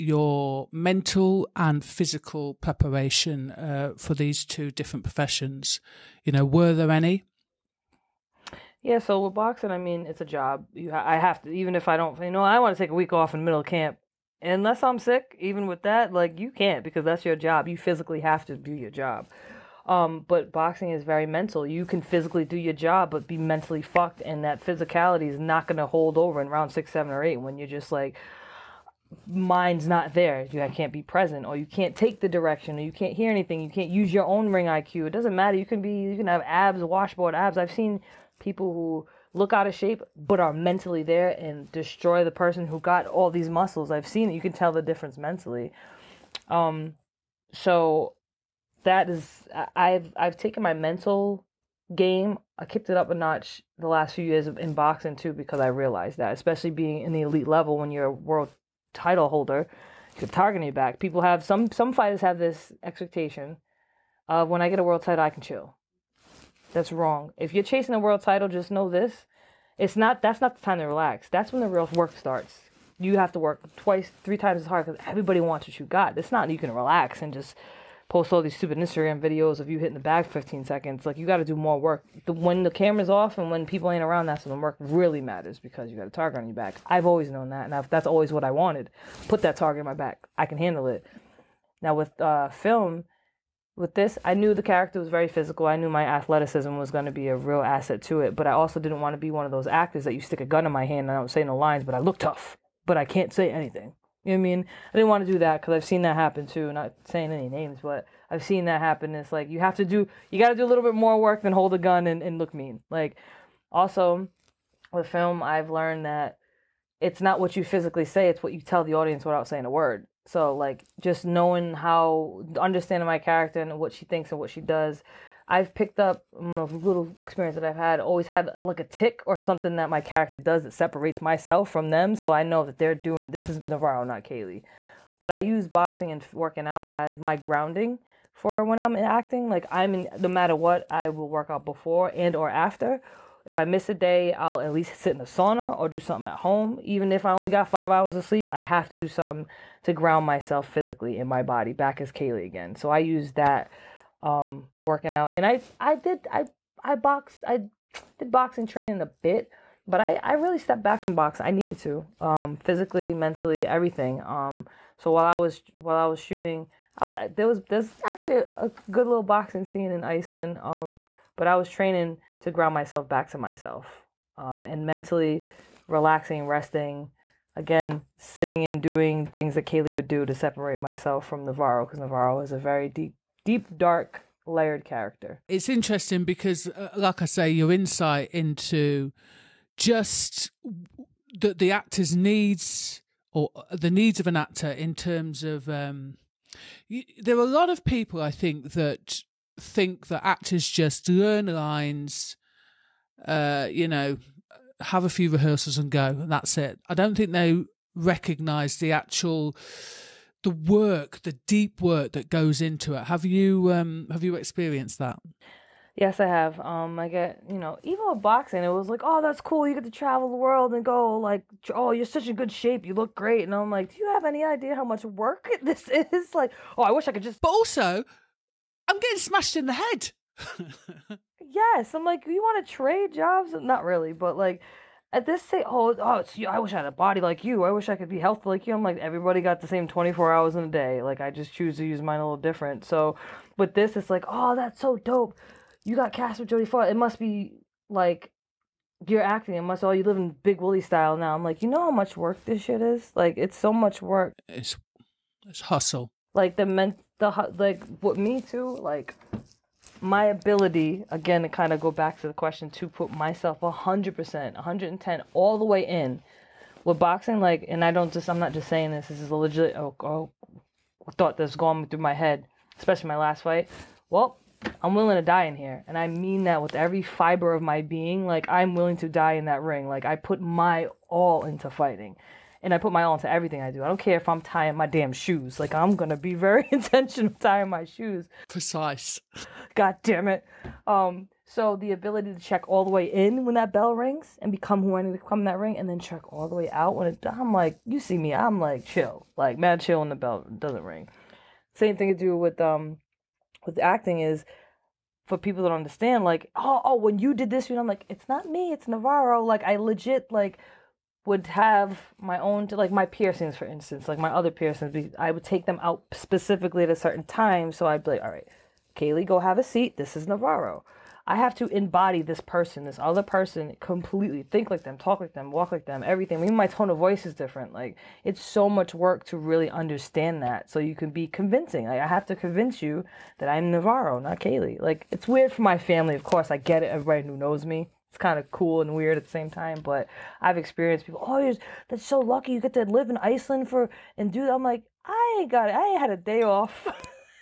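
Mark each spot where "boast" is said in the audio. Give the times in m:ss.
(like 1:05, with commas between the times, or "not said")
not said.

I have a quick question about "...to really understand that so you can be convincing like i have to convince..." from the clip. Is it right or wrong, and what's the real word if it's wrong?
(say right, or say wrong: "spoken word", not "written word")
right.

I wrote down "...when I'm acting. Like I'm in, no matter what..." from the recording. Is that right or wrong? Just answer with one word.
right.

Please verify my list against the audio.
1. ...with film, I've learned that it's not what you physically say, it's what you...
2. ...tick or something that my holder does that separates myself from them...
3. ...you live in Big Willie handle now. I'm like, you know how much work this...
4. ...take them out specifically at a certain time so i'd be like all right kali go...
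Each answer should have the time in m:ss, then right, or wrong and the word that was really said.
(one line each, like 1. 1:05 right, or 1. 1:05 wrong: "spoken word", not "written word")
1. 1:54 right
2. 2:08 wrong: "character", not "holder"
3. 4:09 wrong: "style", not "handle"
4. 5:15 right.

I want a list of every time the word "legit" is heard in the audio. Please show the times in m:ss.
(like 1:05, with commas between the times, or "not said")
4:29, 5:09.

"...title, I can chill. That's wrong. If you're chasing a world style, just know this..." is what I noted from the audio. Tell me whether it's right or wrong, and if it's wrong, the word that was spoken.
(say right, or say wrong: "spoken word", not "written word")
wrong: "title", not "style".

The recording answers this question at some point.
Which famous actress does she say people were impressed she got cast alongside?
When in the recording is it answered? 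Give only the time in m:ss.
4:06.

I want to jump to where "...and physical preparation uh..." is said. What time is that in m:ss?
0:01.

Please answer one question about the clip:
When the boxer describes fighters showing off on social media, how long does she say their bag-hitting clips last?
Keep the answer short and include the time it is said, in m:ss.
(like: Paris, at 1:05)
15 seconds, at 1:20.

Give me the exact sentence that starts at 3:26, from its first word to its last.
I don't think they recognize the actual the work, the deep work that goes into it.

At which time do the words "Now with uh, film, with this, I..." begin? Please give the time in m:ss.
1:31.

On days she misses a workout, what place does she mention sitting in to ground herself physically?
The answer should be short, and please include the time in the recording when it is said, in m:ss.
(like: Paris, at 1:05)
sauna, at 2:25.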